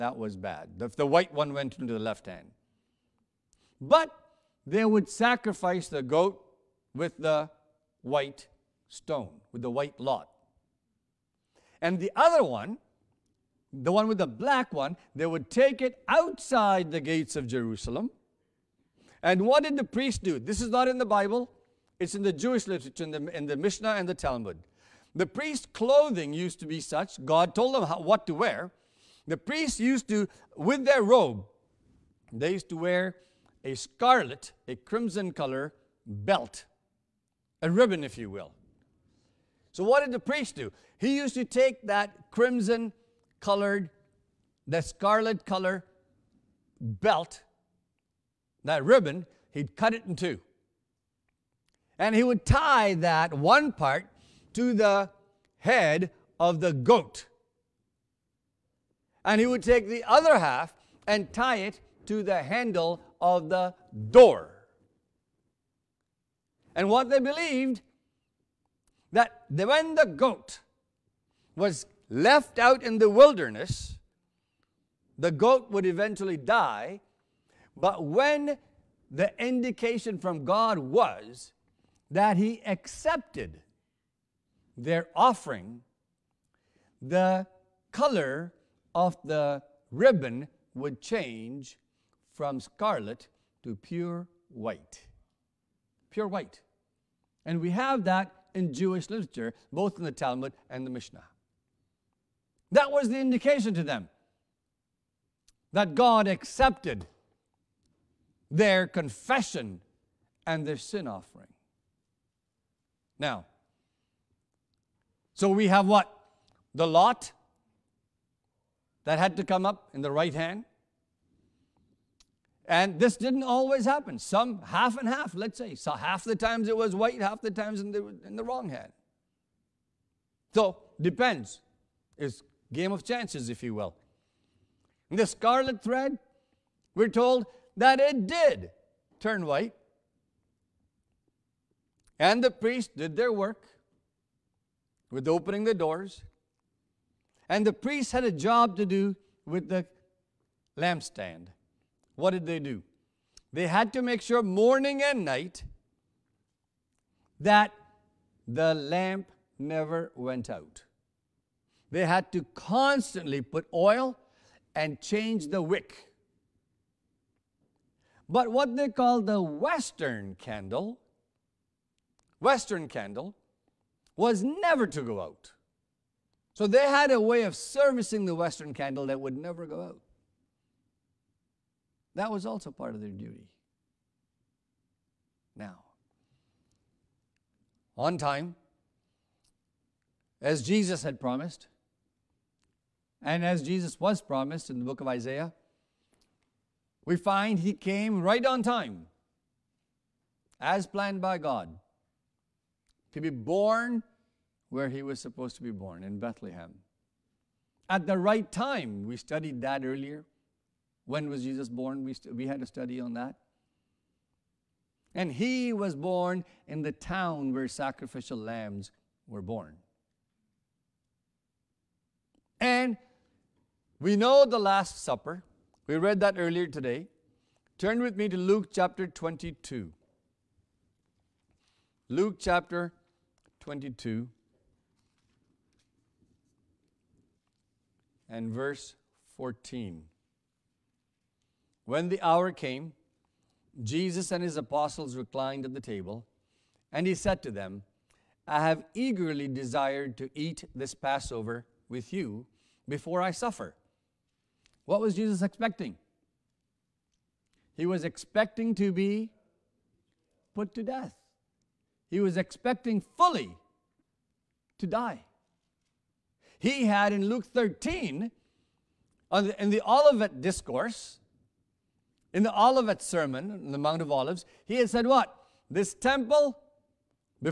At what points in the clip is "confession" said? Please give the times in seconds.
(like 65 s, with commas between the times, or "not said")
108 s.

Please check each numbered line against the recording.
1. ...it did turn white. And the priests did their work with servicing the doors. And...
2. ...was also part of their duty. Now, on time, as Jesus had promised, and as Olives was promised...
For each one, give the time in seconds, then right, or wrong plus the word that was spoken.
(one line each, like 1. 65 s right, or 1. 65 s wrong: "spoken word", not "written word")
1. 137 s wrong: "opening", not "servicing"
2. 182 s wrong: "Jesus", not "Olives".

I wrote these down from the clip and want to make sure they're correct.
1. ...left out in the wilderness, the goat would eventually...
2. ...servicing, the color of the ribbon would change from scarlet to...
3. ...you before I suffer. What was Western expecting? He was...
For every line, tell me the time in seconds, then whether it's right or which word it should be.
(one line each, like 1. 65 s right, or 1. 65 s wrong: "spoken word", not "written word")
1. 72 s right
2. 85 s wrong: "offering", not "servicing"
3. 252 s wrong: "Jesus", not "Western".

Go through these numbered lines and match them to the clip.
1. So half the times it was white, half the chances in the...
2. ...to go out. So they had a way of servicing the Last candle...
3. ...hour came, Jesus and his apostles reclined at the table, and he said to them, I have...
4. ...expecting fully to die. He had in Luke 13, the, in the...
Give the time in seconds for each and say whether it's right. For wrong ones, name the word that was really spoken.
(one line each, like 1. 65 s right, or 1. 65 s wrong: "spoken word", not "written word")
1. 125 s wrong: "times", not "chances"
2. 174 s wrong: "Western", not "Last"
3. 242 s right
4. 262 s right.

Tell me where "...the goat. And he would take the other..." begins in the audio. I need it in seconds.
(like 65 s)
56 s.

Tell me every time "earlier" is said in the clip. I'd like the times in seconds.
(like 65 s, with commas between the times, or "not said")
209 s, 226 s.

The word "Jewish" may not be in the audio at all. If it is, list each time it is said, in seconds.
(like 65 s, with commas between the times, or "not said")
22 s, 98 s.